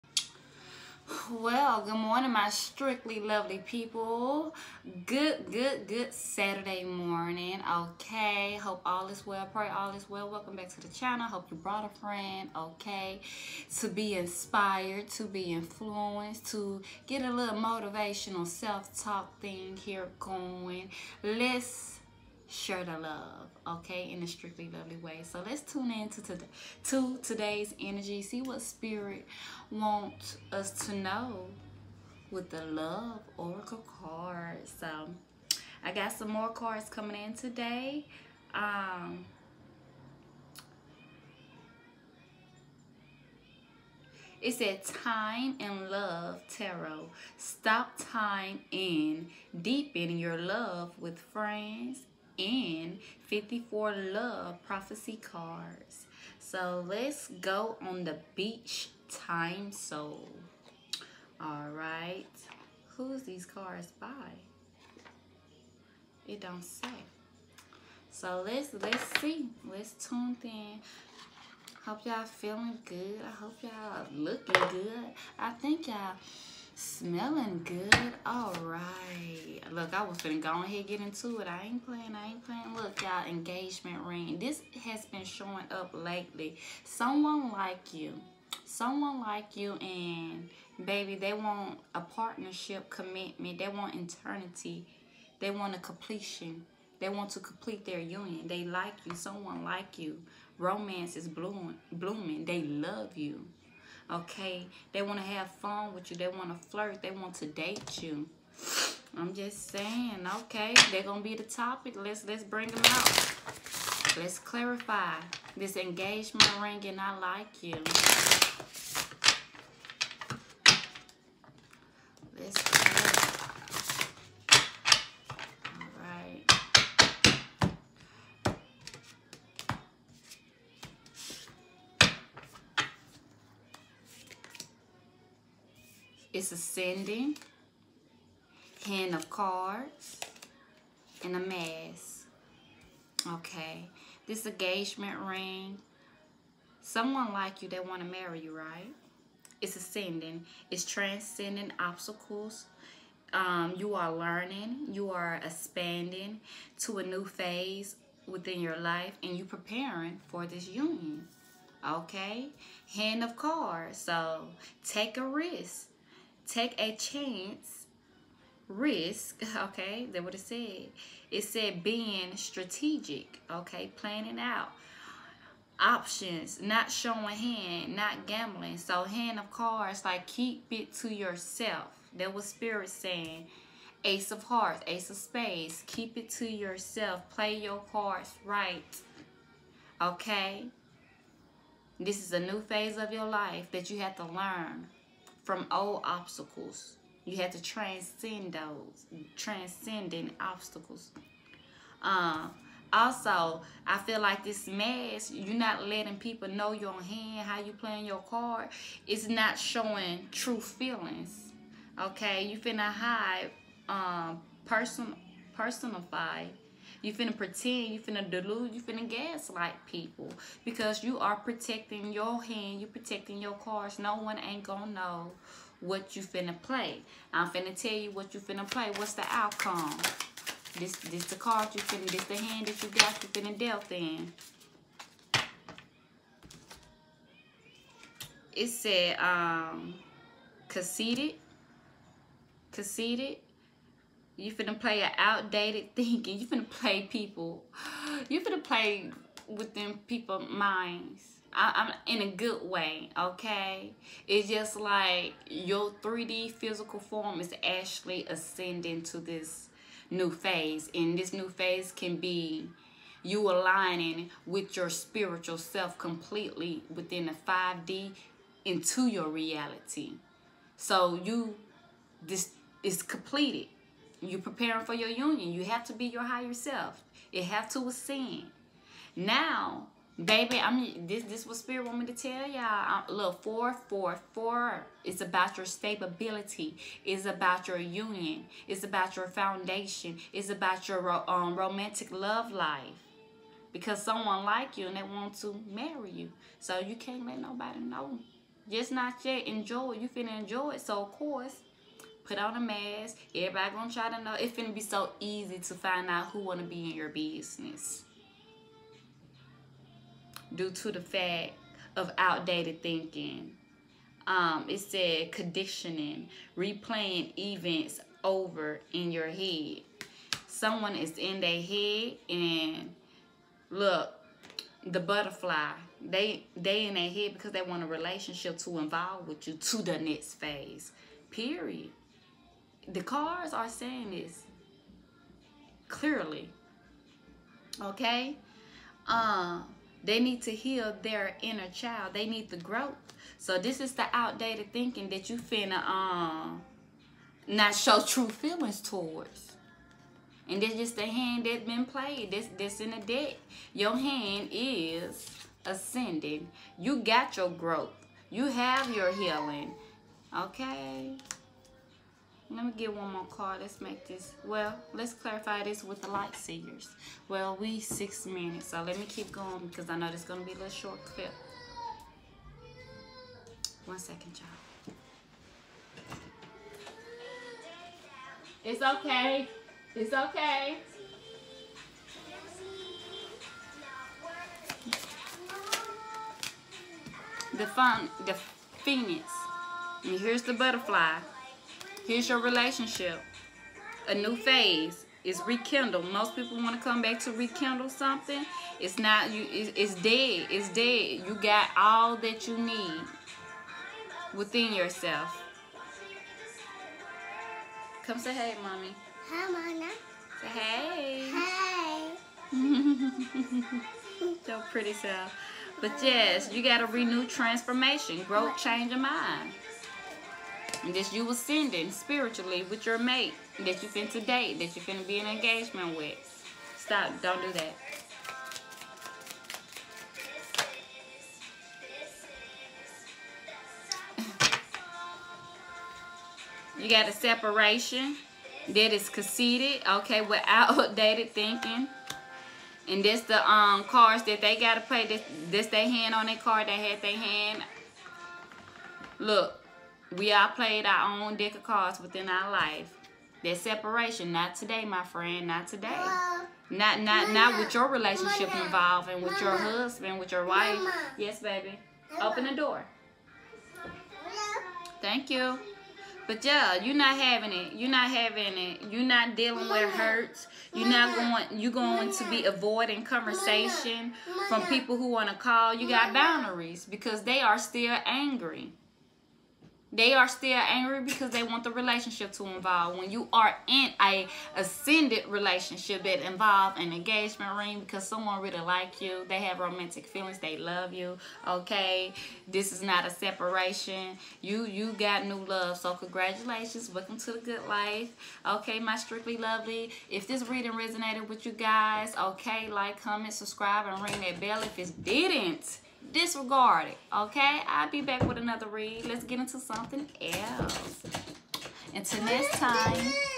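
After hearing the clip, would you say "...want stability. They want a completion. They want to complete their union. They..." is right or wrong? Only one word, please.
wrong.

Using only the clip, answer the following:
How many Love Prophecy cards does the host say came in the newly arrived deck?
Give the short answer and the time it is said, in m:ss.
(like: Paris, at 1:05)
54, at 0:53.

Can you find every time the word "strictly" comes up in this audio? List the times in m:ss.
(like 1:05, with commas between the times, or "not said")
0:02, 0:24, 8:18.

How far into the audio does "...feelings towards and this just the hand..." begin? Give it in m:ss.
5:48.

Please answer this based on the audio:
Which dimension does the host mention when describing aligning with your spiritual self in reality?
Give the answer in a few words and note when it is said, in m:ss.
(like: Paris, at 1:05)
5D, at 4:27.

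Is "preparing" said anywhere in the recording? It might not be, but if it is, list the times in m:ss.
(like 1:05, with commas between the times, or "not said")
2:39, 4:34.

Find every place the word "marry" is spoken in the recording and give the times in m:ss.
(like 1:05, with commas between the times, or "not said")
2:28, 4:55.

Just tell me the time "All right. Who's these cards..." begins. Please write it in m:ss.
1:01.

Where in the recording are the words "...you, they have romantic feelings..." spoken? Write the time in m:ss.
8:09.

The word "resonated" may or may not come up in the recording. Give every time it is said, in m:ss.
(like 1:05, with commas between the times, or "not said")
8:20.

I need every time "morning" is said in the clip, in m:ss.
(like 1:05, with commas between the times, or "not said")
0:01, 0:06.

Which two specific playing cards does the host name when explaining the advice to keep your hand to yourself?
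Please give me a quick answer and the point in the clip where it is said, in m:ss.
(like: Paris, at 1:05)
Ace of hearts, ace of spades, at 3:04.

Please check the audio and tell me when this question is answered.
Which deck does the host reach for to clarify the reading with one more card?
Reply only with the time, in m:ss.
6:06.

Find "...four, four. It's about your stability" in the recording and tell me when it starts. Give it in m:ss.
4:43.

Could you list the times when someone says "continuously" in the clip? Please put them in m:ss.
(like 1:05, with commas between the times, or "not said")
not said.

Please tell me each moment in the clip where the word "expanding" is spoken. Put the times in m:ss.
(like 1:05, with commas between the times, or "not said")
2:35.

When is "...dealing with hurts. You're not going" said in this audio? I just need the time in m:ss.
7:49.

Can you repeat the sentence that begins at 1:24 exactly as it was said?
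This has been showing up lately.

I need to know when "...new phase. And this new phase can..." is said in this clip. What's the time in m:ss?
4:20.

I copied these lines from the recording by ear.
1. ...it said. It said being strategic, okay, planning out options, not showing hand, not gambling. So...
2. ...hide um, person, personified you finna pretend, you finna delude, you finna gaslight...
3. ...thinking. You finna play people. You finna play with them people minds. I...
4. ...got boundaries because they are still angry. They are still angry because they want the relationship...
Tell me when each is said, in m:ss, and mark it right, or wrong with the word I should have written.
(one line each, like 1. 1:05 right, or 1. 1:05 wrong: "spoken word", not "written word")
1. 2:50 right
2. 3:32 right
3. 4:05 right
4. 7:55 right.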